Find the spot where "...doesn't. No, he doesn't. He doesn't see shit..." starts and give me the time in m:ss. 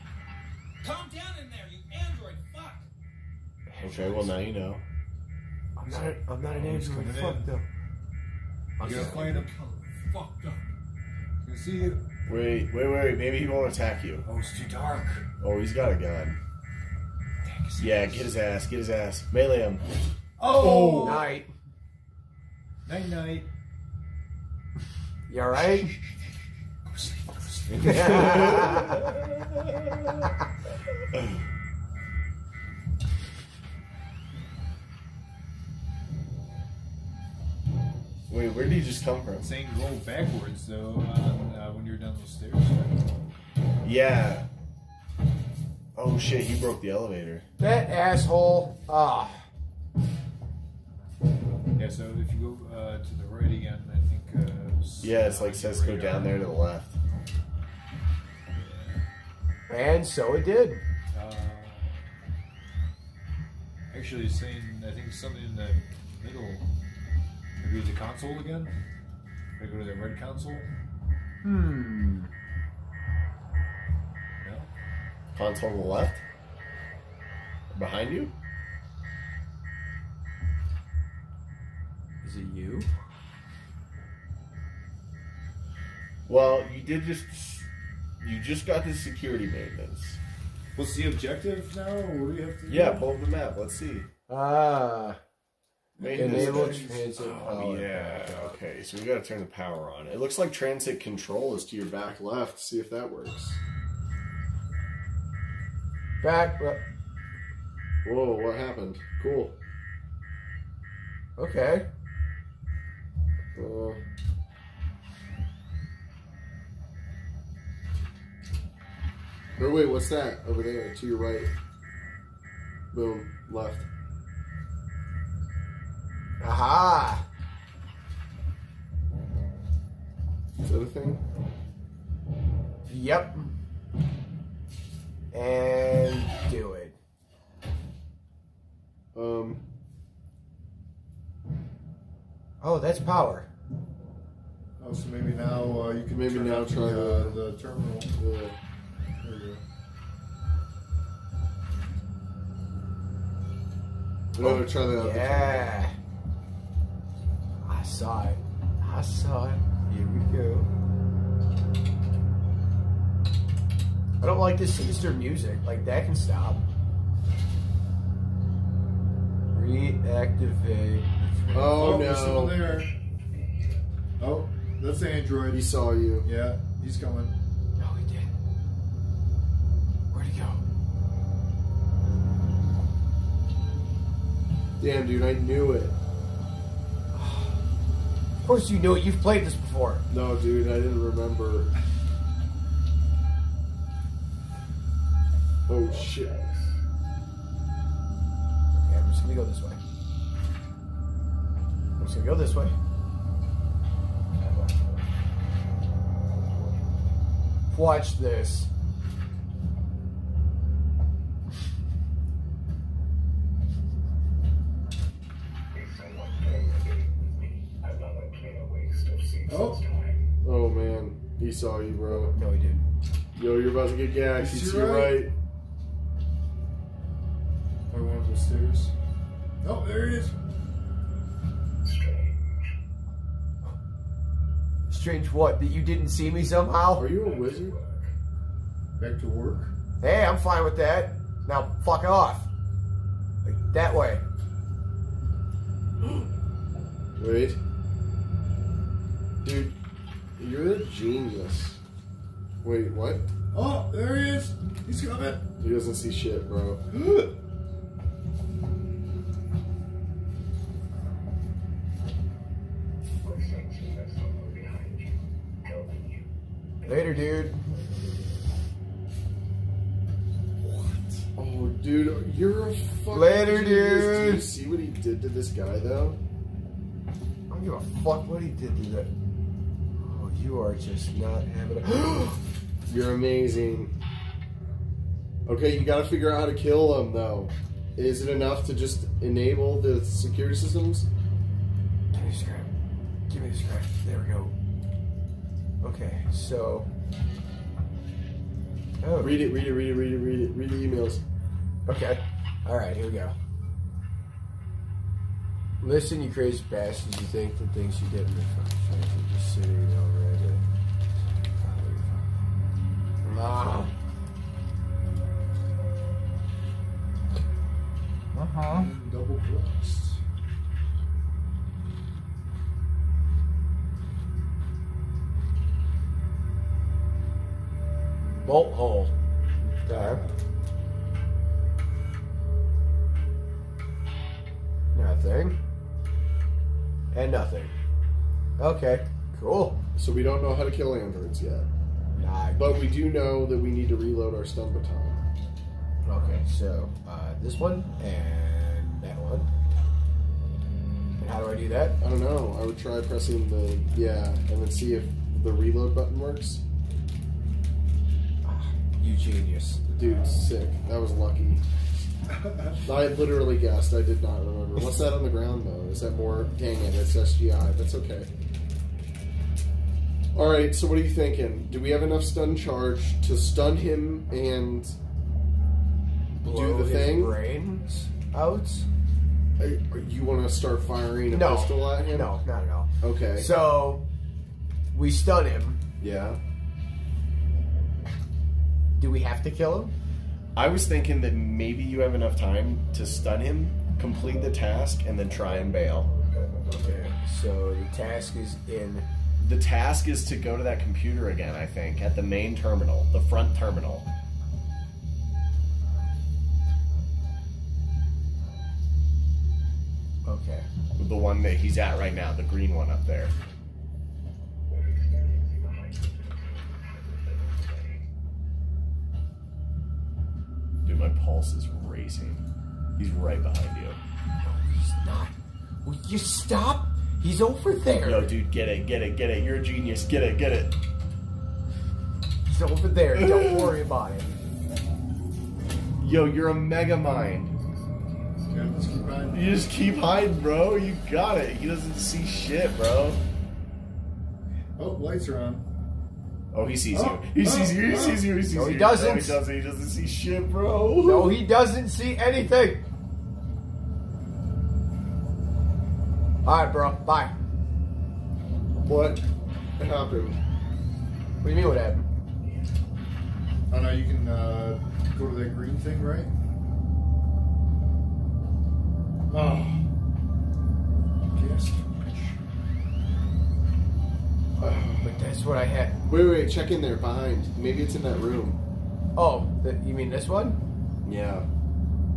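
7:28.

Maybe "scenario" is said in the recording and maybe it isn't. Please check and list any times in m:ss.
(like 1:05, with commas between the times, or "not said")
not said.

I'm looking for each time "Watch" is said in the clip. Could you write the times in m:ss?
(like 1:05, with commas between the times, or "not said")
3:27.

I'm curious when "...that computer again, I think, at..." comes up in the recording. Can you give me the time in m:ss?
6:40.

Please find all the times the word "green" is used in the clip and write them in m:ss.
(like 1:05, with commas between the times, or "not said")
6:52, 7:45.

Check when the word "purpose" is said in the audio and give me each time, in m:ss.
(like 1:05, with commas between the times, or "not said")
not said.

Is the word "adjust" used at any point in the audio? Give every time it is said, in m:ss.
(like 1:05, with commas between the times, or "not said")
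not said.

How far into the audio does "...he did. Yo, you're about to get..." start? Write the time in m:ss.
3:42.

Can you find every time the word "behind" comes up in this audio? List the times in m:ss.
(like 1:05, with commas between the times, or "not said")
1:17, 7:03, 7:56.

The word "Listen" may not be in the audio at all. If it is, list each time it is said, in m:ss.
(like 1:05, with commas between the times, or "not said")
5:05.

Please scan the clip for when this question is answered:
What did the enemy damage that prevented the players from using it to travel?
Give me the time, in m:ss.
0:46.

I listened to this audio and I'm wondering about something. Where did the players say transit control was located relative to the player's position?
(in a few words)
back left.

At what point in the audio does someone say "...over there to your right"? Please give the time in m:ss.
2:00.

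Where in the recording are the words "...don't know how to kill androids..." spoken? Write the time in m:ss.
5:40.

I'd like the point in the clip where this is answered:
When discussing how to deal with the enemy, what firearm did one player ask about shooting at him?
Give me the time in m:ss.
6:21.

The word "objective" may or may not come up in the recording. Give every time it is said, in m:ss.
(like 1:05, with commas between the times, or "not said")
1:31.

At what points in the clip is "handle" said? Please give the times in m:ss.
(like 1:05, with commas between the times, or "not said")
not said.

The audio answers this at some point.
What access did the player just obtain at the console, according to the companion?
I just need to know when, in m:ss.
1:28.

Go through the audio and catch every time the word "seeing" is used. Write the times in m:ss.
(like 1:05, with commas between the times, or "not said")
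1:04.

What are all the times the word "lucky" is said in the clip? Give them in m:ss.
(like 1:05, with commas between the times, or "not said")
6:01.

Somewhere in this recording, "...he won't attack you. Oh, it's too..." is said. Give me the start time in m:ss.
0:13.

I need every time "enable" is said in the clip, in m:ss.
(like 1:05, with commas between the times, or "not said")
1:36, 4:49.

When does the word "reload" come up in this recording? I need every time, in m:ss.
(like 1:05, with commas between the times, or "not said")
5:43, 5:55.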